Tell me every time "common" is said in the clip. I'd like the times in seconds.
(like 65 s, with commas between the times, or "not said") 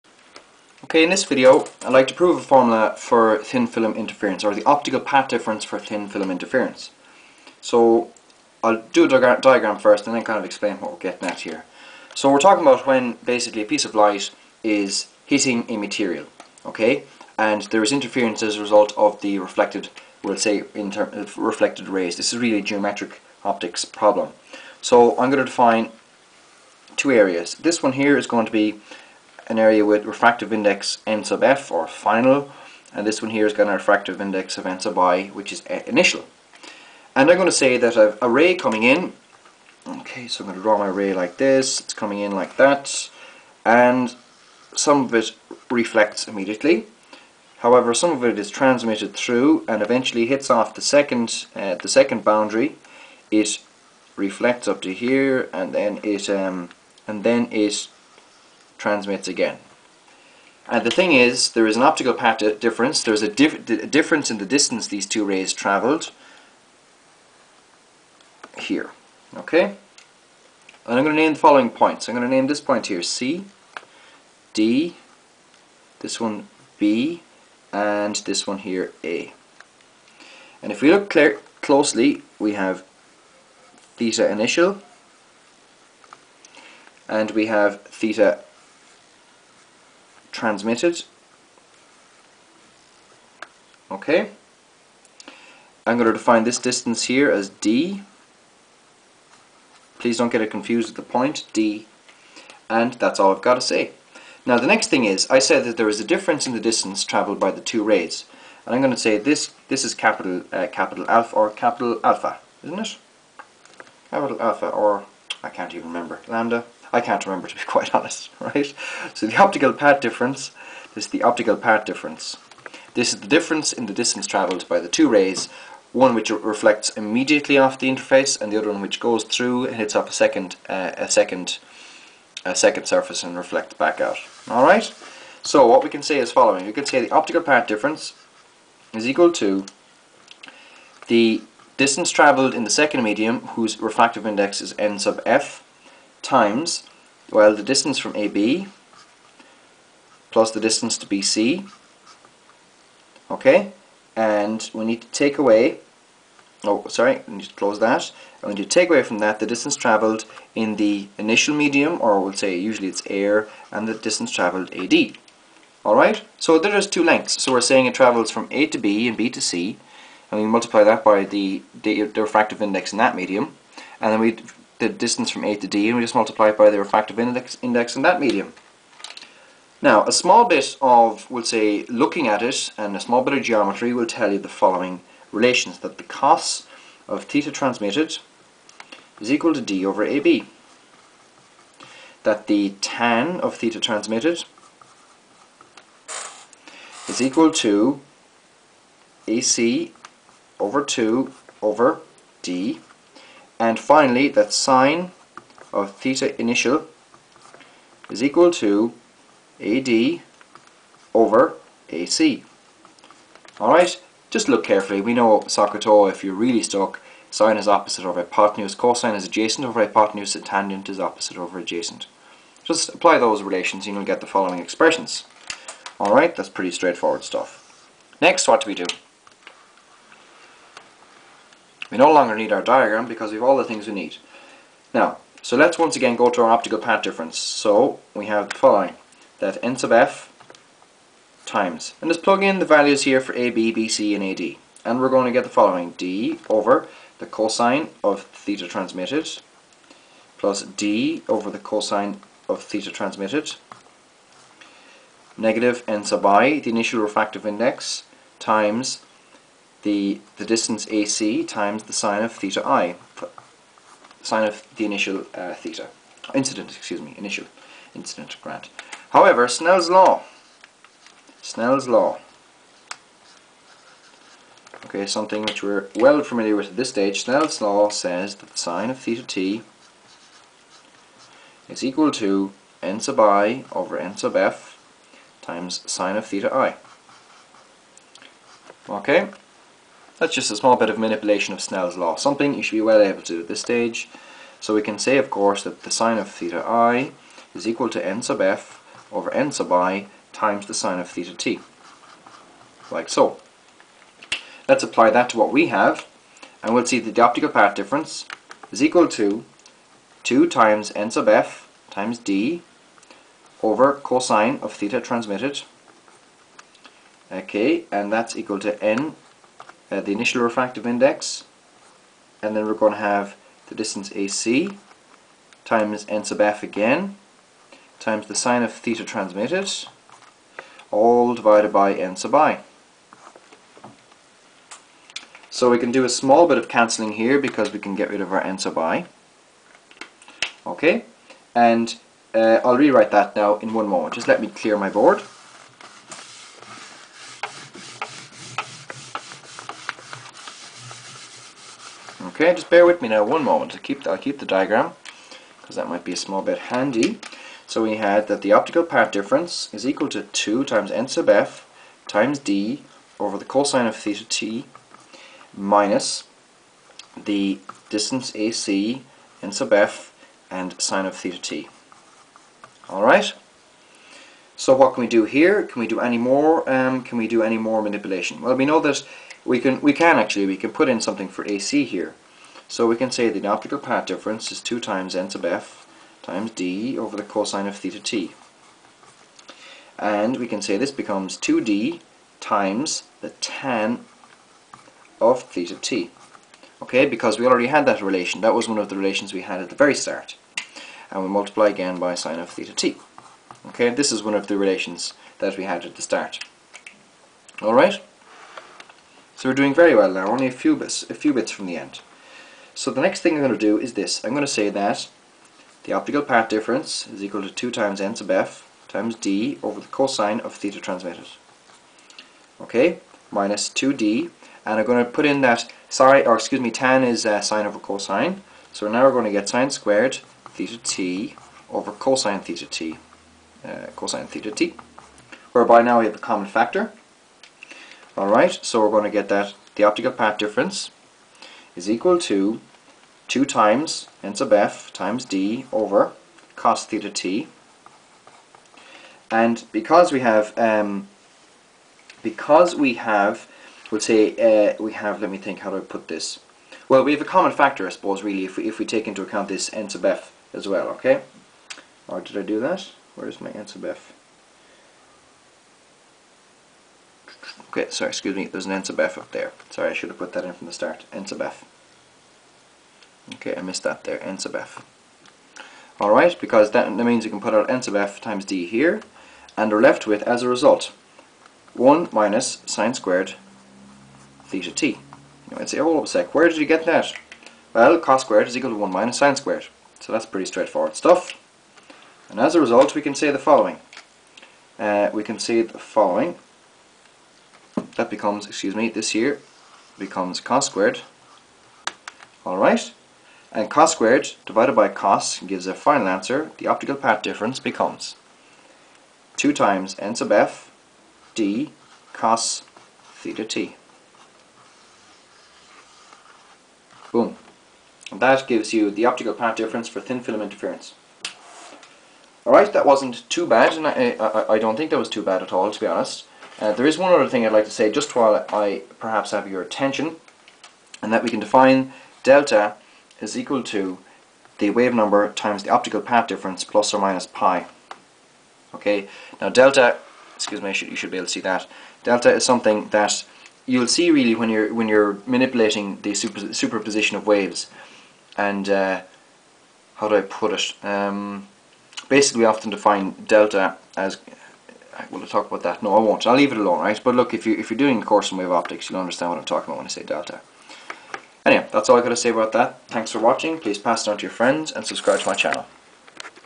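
436 s, 457 s.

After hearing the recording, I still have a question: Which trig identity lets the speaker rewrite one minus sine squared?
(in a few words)
cos squared equals 1 minus sine squared.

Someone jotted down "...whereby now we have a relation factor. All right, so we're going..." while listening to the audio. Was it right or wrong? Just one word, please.
wrong.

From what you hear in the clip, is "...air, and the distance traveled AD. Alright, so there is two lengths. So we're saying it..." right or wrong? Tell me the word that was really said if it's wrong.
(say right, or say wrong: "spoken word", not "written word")
right.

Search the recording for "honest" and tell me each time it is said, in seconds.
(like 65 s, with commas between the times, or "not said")
117 s, 525 s.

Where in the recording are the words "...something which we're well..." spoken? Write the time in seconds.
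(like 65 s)
275 s.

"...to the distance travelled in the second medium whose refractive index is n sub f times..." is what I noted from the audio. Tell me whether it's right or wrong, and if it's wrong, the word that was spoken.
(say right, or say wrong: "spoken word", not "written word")
right.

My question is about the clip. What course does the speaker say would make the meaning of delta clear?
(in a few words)
wave optics.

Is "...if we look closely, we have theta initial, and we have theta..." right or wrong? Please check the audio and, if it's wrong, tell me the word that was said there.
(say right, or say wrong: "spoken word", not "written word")
right.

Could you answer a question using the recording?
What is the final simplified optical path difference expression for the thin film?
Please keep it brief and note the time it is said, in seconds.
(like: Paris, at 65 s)
2 n_f d cos theta_t, at 509 s.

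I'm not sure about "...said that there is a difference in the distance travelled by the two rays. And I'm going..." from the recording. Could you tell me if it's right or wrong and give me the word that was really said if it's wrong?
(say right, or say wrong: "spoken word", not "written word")
right.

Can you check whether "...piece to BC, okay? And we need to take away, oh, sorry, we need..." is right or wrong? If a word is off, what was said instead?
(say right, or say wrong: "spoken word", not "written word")
wrong: "distance", not "piece".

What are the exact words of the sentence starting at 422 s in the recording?
Okay, minus 2d, and I'm going to put in that sorry, or excuse me, tan is uh, sine over cosine.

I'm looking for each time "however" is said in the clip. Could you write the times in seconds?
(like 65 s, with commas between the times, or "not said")
47 s, 269 s.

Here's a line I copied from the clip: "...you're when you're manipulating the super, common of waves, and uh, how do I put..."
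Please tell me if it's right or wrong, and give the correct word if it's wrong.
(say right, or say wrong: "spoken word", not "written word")
wrong: "superposition", not "common".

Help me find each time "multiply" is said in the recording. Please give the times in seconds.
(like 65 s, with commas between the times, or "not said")
170 s, 176 s, 401 s.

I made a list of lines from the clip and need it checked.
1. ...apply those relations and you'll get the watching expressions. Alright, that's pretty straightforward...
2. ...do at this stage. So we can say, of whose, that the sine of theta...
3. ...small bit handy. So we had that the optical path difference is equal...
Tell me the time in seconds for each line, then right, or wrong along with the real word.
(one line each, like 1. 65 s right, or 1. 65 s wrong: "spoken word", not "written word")
1. 222 s wrong: "following", not "watching"
2. 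293 s wrong: "course", not "whose"
3. 356 s right.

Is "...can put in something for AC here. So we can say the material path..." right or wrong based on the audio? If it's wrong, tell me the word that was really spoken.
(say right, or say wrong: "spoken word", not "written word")
wrong: "optical", not "material".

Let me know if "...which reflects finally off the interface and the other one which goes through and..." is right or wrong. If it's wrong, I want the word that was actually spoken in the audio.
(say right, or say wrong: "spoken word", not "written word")
wrong: "immediately", not "finally".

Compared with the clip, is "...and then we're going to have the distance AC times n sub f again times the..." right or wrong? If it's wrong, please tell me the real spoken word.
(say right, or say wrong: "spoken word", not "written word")
right.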